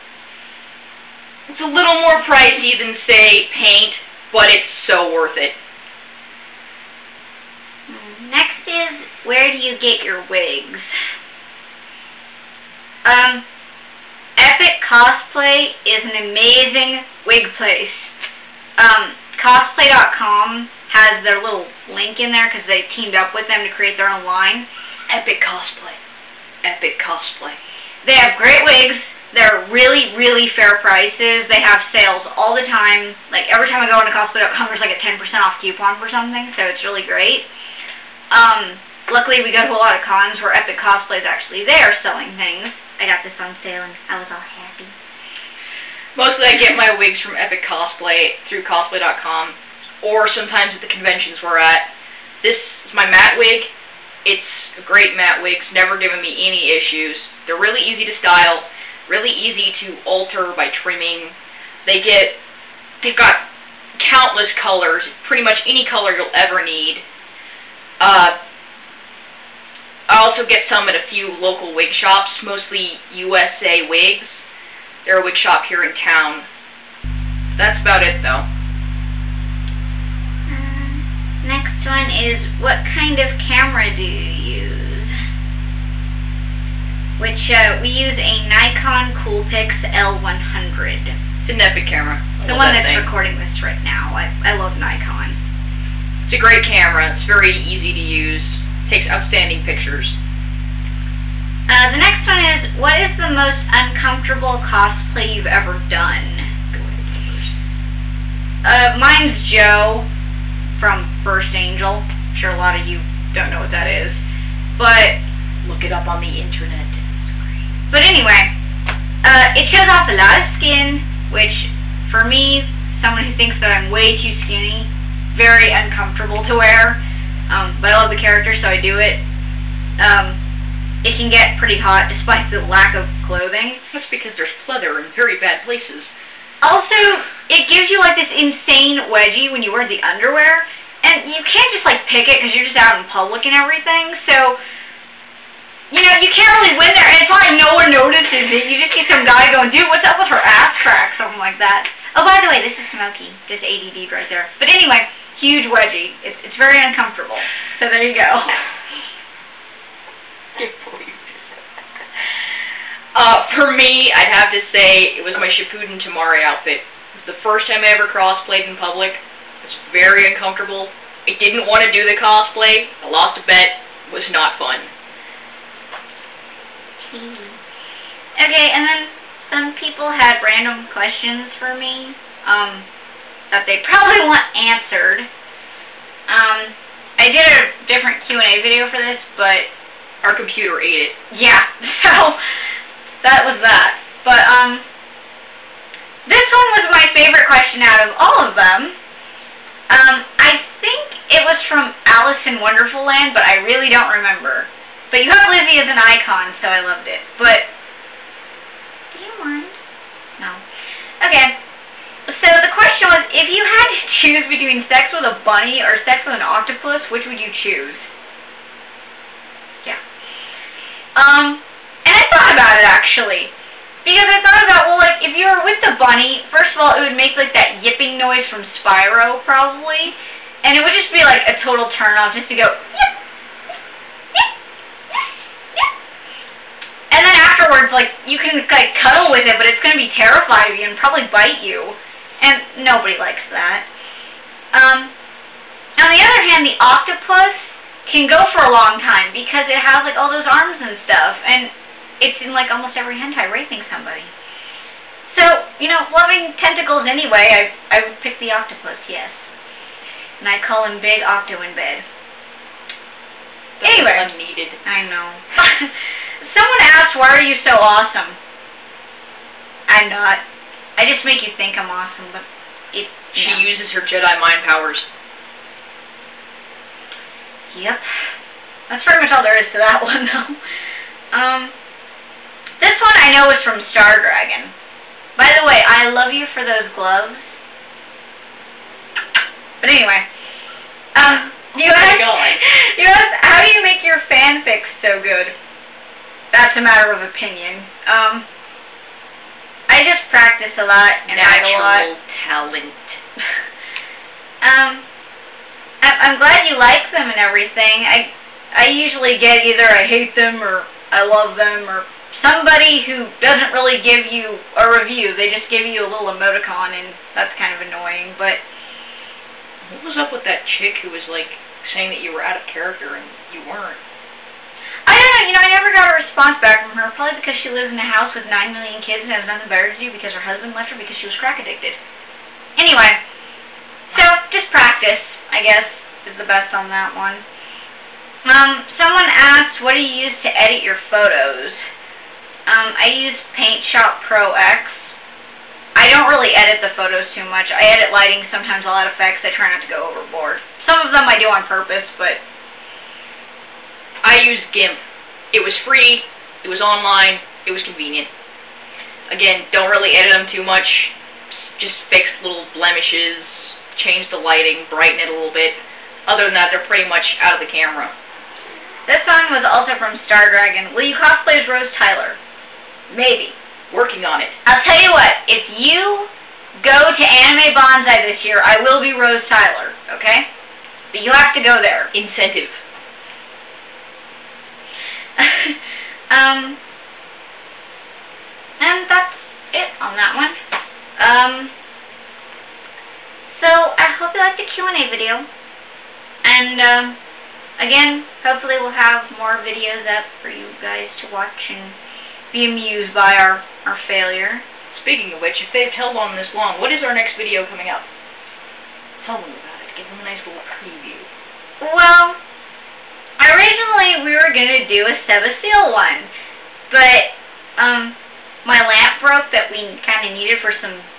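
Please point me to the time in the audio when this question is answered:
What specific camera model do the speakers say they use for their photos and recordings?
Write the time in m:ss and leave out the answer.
1:28.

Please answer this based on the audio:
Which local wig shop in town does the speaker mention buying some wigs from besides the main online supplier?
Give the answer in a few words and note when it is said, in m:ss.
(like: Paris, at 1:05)
USA Wigs, at 1:13.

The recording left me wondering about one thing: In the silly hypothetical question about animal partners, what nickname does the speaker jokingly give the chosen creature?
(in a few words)
Big Octo.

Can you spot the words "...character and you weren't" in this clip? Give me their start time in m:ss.
5:22.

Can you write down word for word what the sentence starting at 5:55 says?
It was free, it was online, it was convenient.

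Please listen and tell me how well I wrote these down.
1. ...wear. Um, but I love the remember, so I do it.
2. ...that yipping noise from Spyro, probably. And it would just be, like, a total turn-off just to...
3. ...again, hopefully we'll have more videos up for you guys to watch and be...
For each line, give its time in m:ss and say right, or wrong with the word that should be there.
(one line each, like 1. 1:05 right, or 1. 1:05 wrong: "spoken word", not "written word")
1. 2:06 wrong: "character", not "remember"
2. 3:47 right
3. 6:37 right.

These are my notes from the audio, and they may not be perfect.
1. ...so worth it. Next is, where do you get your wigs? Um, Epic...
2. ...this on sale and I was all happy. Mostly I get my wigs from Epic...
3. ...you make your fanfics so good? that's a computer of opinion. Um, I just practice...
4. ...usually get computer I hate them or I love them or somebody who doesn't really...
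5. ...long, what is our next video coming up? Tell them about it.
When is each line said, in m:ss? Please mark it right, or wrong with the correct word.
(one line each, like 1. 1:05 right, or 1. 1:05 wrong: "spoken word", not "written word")
1. 0:04 right
2. 0:43 right
3. 4:53 wrong: "matter", not "computer"
4. 5:08 wrong: "either", not "computer"
5. 6:46 right.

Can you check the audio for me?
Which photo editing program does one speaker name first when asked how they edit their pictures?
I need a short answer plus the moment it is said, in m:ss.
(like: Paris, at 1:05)
Paint Shop Pro X, at 5:43.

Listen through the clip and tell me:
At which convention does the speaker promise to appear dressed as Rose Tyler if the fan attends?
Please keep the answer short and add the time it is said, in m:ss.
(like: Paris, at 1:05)
Anime Banzai, at 6:17.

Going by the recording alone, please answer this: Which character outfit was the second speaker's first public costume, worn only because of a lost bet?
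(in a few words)
Shippuden Temari.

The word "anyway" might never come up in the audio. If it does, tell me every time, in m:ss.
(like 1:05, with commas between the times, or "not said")
1:58, 2:34, 4:17, 4:23, 4:49, 5:32.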